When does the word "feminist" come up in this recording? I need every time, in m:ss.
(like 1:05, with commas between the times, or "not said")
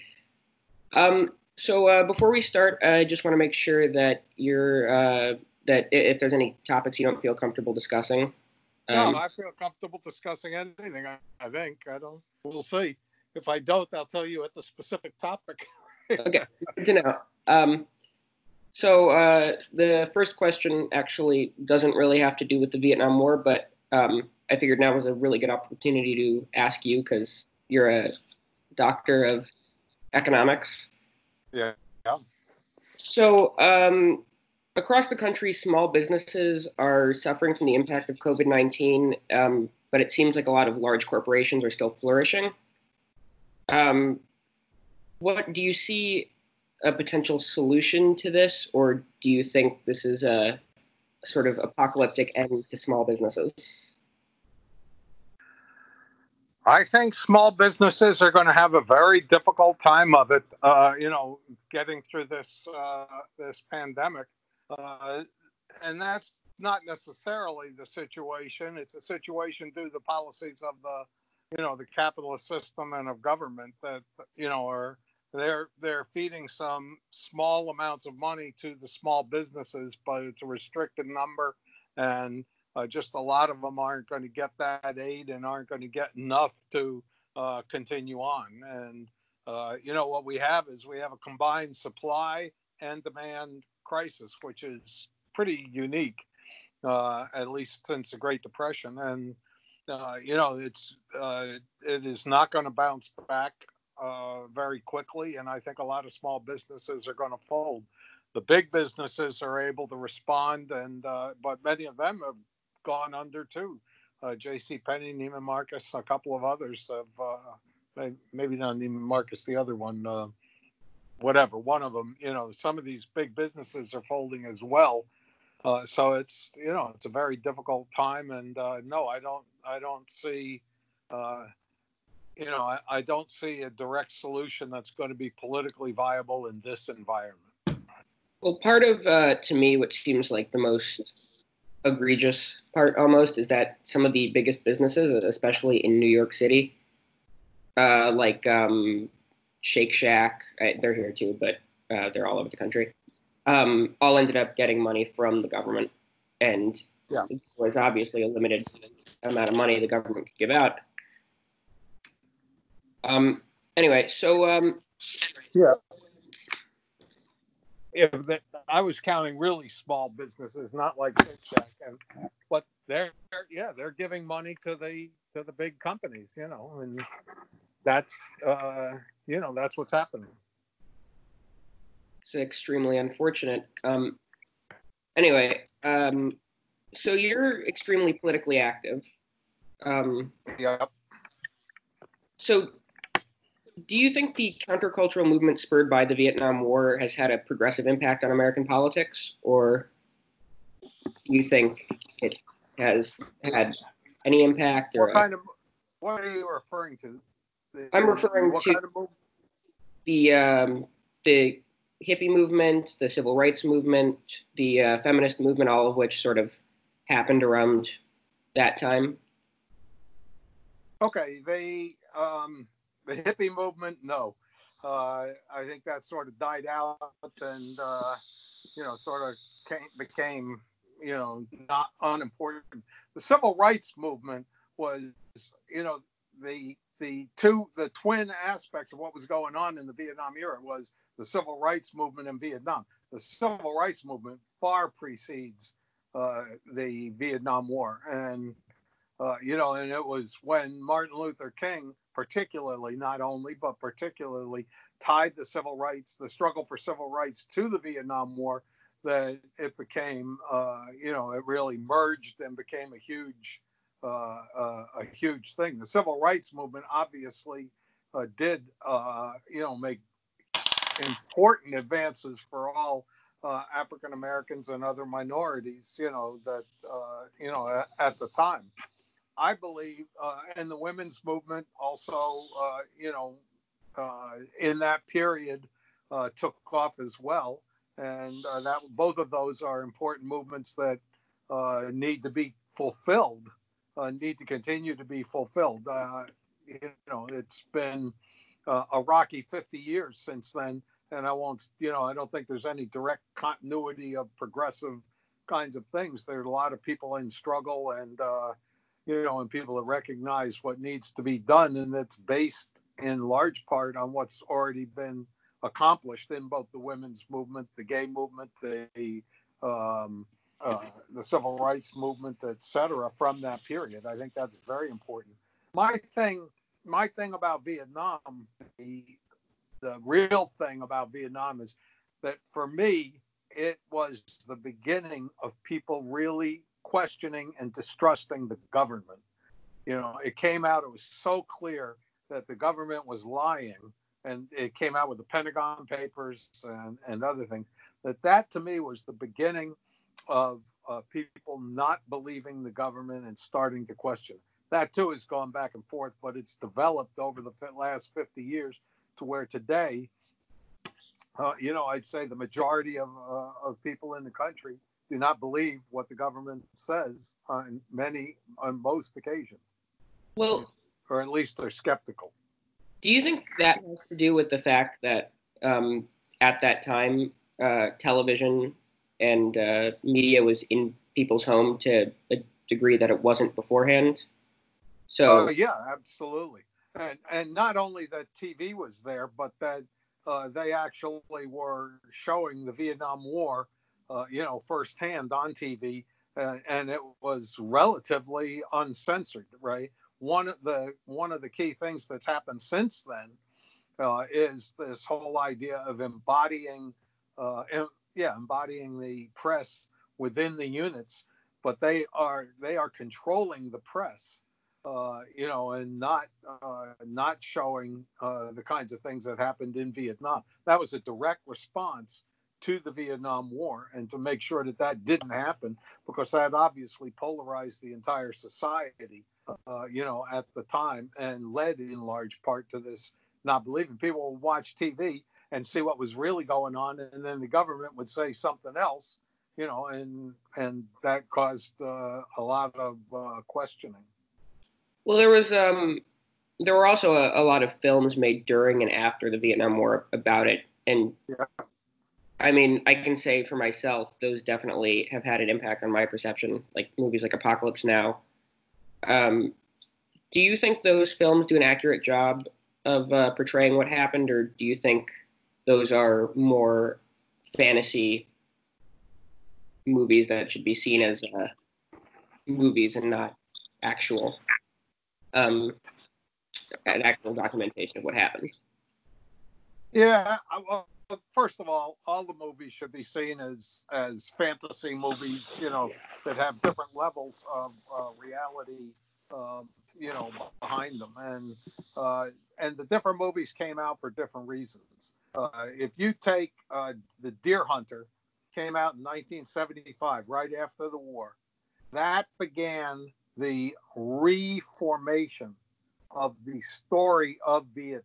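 3:35.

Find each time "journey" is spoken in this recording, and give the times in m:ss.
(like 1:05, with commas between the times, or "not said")
not said.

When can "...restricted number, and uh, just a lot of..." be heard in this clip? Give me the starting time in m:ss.
1:20.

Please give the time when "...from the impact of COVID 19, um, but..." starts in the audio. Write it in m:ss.
0:37.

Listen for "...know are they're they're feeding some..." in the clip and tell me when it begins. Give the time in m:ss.
1:14.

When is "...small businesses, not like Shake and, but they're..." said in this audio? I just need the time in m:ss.
2:49.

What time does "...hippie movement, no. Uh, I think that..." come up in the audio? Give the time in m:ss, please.
3:43.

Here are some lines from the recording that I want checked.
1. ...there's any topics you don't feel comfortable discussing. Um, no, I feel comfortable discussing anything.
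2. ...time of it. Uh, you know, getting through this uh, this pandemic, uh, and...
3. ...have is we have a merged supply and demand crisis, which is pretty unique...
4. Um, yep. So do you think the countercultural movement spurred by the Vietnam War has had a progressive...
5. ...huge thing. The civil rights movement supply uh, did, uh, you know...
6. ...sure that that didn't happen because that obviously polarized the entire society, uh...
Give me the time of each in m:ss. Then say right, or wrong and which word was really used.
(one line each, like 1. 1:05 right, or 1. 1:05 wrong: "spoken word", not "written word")
1. 0:06 right
2. 0:59 right
3. 1:30 wrong: "combined", not "merged"
4. 3:09 right
5. 4:25 wrong: "obviously", not "supply"
6. 7:04 right.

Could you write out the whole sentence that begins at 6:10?
Well, or at least they're skeptical.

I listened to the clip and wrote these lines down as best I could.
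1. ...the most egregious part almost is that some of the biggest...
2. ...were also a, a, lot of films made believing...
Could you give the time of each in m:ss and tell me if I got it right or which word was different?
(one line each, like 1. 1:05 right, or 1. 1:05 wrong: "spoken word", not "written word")
1. 2:20 right
2. 7:26 wrong: "during", not "believing".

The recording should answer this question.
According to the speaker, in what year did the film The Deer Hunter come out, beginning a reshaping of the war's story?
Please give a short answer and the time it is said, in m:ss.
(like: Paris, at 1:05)
1975, at 8:18.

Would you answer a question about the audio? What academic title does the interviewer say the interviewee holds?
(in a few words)
Doctor of economics.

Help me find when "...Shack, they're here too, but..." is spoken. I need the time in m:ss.
2:29.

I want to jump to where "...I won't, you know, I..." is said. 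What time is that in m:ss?
5:01.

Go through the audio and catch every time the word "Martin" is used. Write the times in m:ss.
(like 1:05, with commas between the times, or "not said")
4:10.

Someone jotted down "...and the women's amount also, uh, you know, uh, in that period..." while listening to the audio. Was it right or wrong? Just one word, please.
wrong.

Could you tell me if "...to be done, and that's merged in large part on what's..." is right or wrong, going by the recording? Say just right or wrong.
wrong.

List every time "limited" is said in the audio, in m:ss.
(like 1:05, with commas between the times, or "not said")
2:38.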